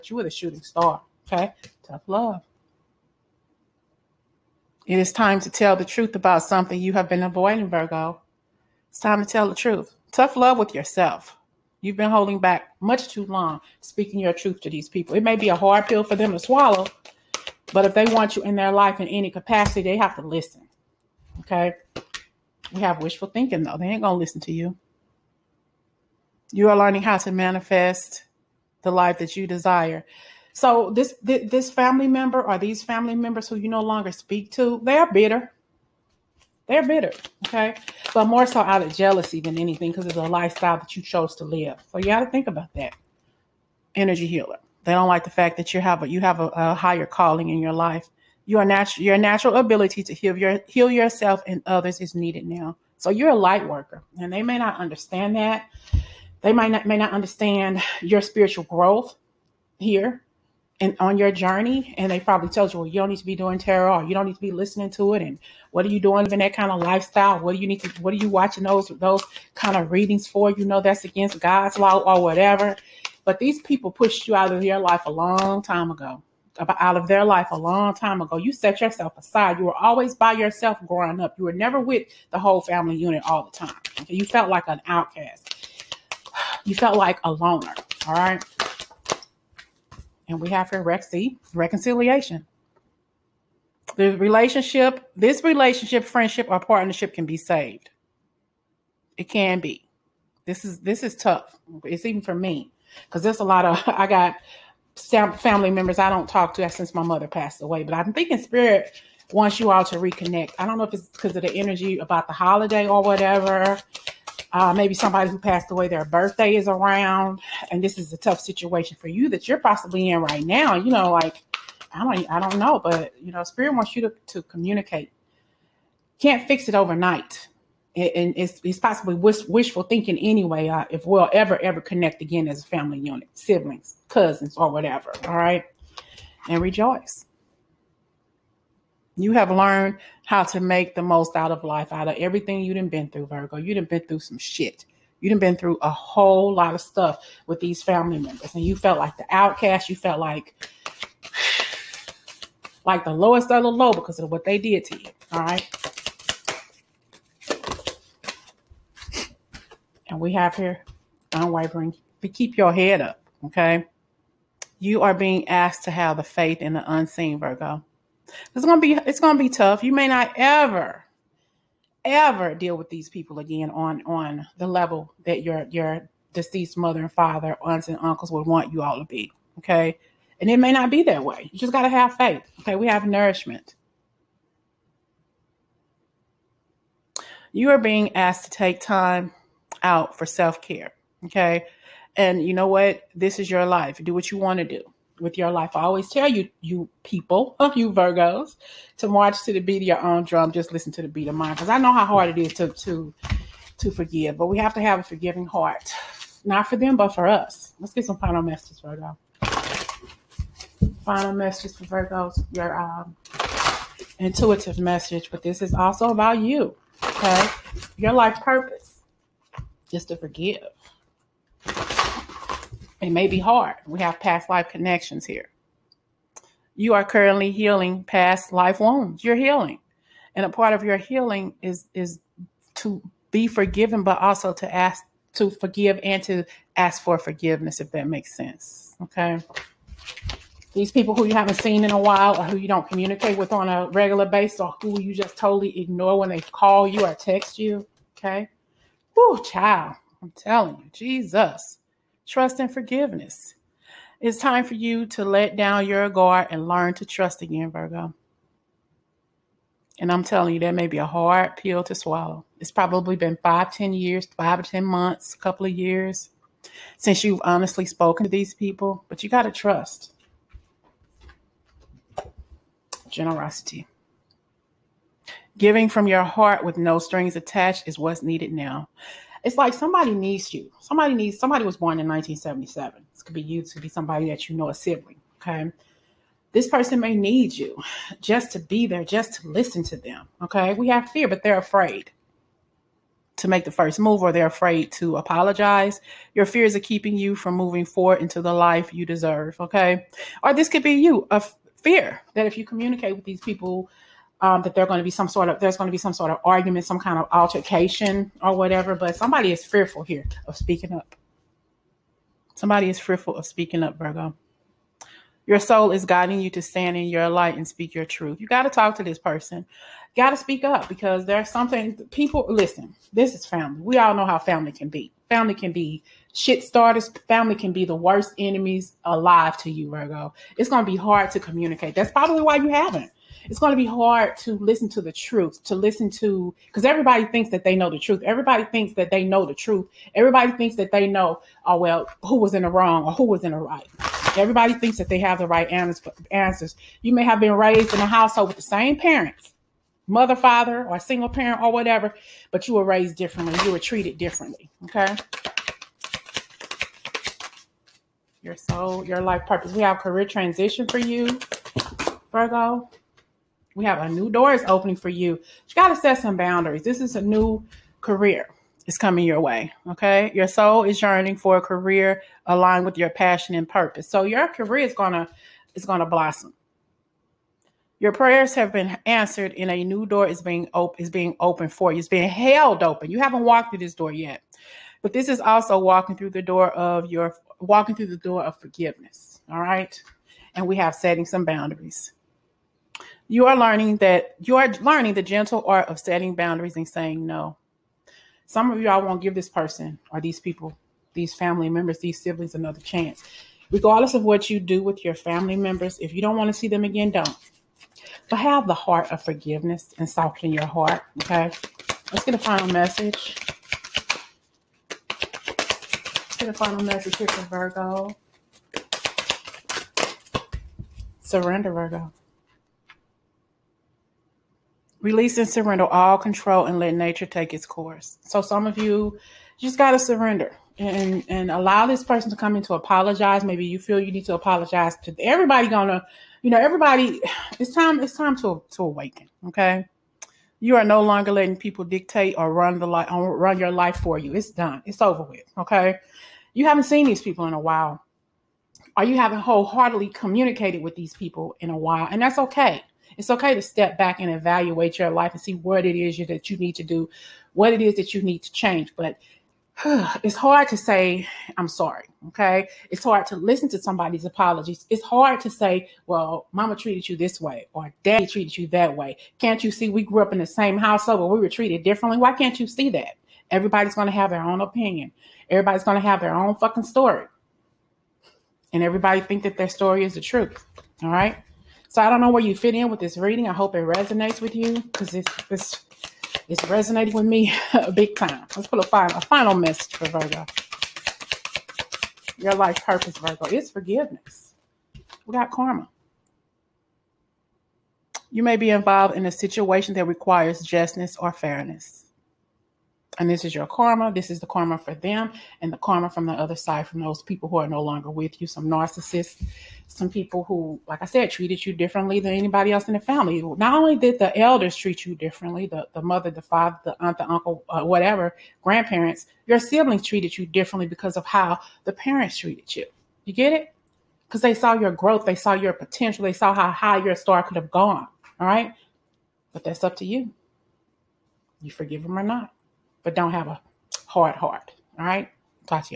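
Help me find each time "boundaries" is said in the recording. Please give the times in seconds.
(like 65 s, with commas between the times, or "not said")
366 s, 391 s, 396 s.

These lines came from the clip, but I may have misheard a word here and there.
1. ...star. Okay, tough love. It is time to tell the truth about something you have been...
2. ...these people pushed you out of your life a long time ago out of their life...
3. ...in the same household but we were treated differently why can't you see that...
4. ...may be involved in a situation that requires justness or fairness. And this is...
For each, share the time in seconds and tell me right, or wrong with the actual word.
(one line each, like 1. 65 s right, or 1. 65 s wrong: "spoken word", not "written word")
1. 0 s right
2. 73 s right
3. 470 s right
4. 498 s right.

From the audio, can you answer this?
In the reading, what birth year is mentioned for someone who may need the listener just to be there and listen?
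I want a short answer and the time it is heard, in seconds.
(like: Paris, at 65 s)
1977, at 282 s.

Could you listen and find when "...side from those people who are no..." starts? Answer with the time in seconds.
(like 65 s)
506 s.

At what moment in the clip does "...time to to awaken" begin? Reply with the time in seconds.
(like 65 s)
438 s.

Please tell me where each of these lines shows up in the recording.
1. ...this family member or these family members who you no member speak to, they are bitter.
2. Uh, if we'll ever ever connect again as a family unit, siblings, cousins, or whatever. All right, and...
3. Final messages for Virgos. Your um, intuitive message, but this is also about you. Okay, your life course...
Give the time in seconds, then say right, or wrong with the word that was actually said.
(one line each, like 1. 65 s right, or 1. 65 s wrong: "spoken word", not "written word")
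1. 31 s wrong: "longer", not "member"
2. 130 s right
3. 211 s wrong: "purpose", not "course".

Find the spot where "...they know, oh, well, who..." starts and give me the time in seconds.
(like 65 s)
340 s.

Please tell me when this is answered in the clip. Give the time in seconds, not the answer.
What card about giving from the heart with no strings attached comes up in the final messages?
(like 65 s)
273 s.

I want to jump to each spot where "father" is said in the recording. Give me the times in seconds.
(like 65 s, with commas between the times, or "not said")
177 s, 350 s, 516 s.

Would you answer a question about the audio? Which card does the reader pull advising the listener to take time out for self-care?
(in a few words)
Nourishment.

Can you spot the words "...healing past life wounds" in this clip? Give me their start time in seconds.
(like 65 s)
227 s.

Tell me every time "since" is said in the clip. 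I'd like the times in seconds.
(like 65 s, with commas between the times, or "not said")
106 s, 266 s.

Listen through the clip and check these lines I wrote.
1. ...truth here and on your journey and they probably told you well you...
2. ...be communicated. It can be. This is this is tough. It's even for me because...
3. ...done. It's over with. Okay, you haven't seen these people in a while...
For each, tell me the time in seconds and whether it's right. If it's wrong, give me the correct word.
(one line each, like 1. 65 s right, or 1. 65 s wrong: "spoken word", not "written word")
1. 58 s wrong: "growth", not "truth"
2. 97 s wrong: "saved", not "communicated"
3. 444 s right.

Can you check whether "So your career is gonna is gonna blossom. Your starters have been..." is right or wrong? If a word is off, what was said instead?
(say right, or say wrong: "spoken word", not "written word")
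wrong: "prayers", not "starters".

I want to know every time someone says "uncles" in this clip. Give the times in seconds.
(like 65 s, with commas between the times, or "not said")
178 s, 517 s.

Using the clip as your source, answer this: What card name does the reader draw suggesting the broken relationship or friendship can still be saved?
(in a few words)
Reconciliation.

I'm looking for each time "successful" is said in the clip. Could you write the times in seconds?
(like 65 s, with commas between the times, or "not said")
not said.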